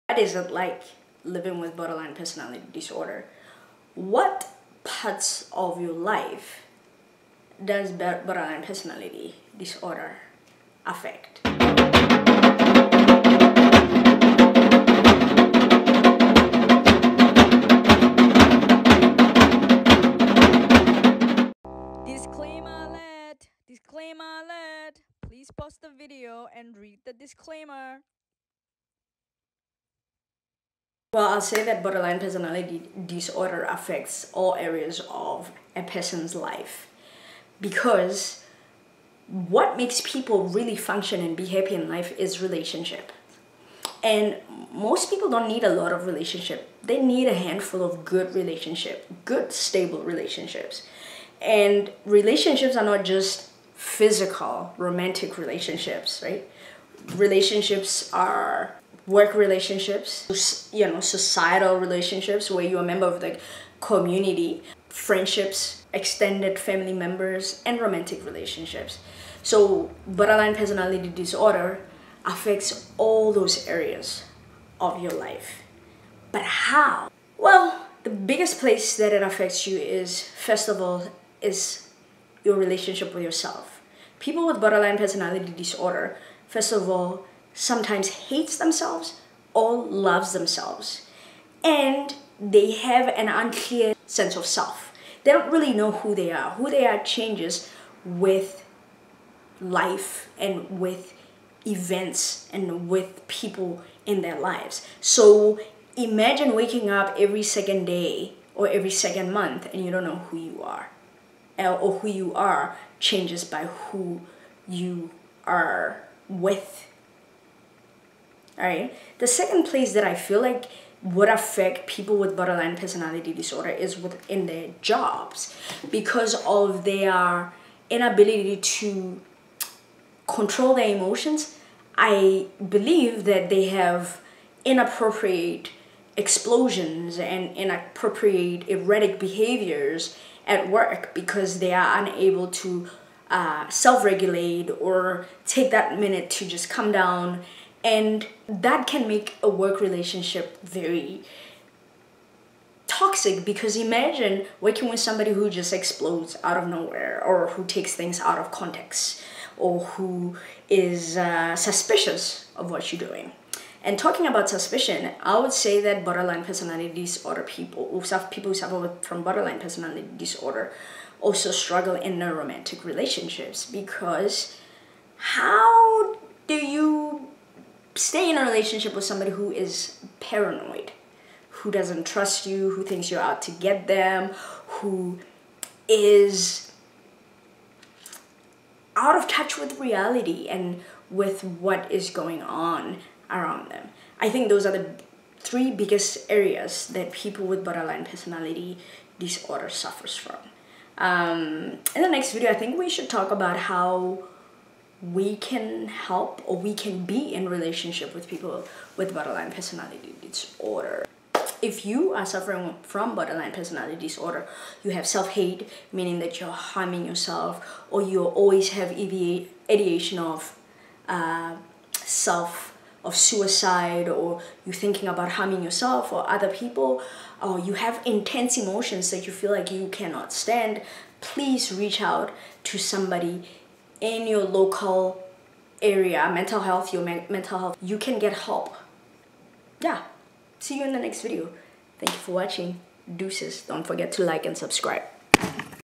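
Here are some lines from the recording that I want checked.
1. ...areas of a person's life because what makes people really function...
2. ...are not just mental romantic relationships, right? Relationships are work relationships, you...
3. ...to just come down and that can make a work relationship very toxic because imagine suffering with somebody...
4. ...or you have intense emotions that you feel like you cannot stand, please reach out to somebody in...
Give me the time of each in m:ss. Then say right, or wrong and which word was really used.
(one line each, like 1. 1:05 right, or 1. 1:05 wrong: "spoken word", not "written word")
1. 0:34 right
2. 0:52 wrong: "physical", not "mental"
3. 2:26 wrong: "working", not "suffering"
4. 3:47 right.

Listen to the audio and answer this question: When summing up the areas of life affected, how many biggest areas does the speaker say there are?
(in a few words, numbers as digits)
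3.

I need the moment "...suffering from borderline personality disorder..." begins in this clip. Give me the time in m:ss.
3:32.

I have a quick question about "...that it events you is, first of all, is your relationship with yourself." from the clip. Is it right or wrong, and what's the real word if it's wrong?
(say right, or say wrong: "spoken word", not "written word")
wrong: "affects", not "events".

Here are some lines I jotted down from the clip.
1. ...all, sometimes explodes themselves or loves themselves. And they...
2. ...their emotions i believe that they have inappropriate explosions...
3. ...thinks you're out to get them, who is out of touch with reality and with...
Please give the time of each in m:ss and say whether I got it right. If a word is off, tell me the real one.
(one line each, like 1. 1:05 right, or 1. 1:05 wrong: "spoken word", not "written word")
1. 1:26 wrong: "hates", not "explodes"
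2. 2:10 right
3. 3:02 right.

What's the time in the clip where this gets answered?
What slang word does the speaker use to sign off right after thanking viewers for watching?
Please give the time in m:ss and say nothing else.
4:03.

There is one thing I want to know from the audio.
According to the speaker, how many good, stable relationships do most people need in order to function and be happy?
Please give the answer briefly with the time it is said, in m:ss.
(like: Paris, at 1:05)
A handful, at 0:47.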